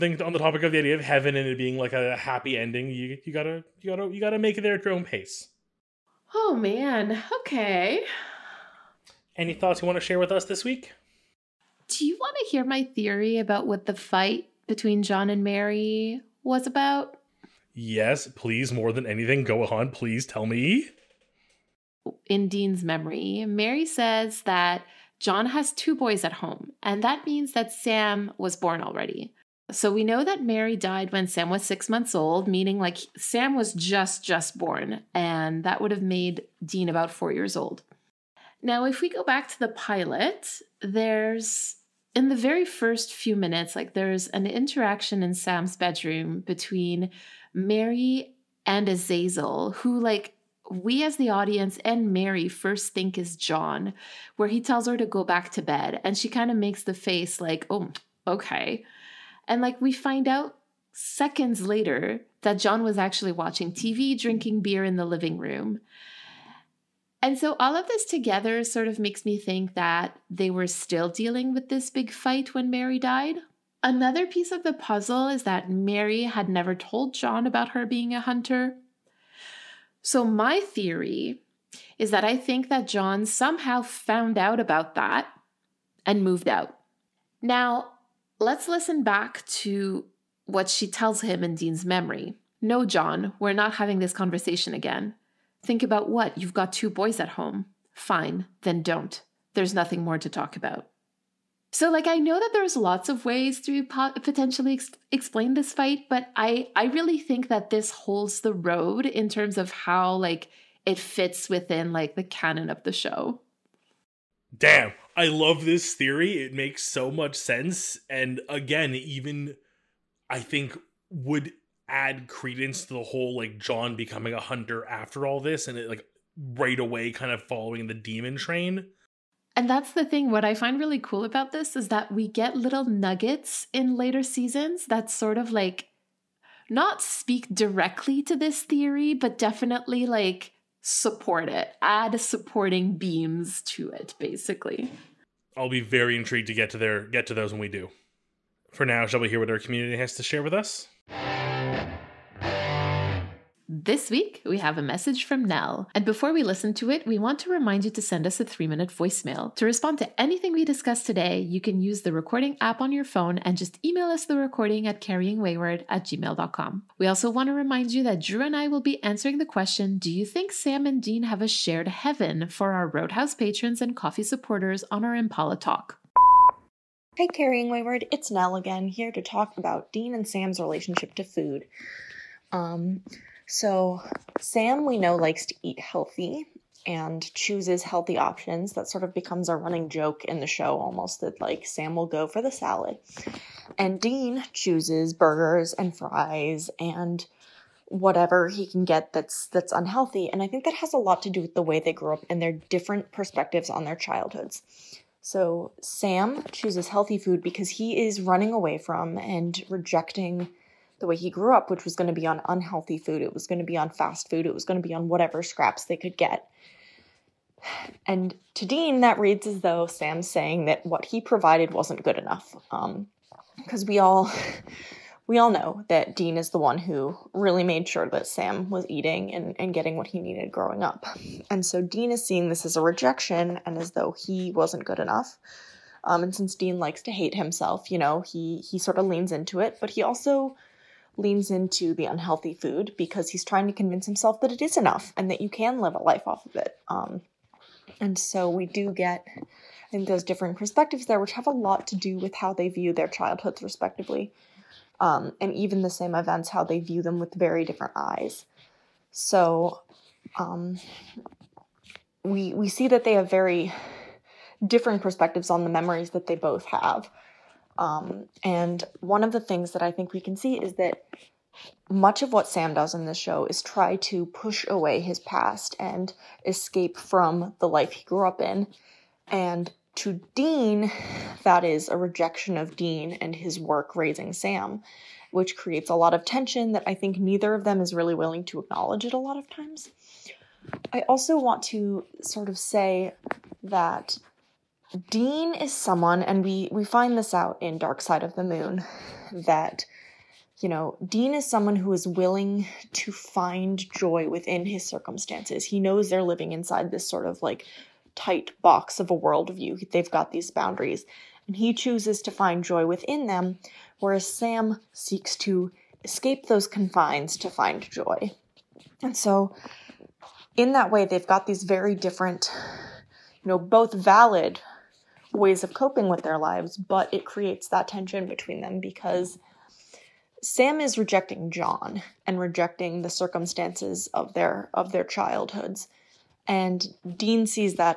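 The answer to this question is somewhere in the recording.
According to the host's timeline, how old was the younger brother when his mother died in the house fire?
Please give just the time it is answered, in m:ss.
0:31.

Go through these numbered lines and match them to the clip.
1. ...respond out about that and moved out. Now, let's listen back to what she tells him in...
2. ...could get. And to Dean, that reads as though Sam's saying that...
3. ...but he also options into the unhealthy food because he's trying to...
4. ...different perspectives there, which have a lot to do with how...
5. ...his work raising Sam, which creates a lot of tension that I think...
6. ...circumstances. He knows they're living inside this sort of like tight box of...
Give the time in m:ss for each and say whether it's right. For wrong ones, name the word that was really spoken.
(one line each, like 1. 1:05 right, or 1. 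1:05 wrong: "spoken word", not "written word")
1. 1:23 wrong: "found", not "respond"
2. 3:35 right
3. 3:59 wrong: "leans", not "options"
4. 4:10 right
5. 4:43 right
6. 5:04 right.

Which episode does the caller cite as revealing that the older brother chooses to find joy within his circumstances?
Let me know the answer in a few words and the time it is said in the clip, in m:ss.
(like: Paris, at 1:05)
Dark Side of the Moon, at 4:57.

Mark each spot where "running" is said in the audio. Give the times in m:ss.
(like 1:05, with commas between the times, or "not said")
3:09, 3:28.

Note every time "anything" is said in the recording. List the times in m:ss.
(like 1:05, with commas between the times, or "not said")
0:19, 2:40.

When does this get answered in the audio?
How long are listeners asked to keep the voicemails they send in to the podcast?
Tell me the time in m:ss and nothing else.
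2:38.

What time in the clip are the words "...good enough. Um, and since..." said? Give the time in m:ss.
3:54.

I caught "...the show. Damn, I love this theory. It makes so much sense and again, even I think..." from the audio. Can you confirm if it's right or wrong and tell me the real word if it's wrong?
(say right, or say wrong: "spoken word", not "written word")
right.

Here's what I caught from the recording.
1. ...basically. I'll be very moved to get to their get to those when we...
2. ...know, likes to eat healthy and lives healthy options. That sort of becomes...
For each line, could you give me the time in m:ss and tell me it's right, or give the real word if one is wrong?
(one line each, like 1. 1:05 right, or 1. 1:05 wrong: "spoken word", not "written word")
1. 2:24 wrong: "intrigued", not "moved"
2. 3:04 wrong: "chooses", not "lives".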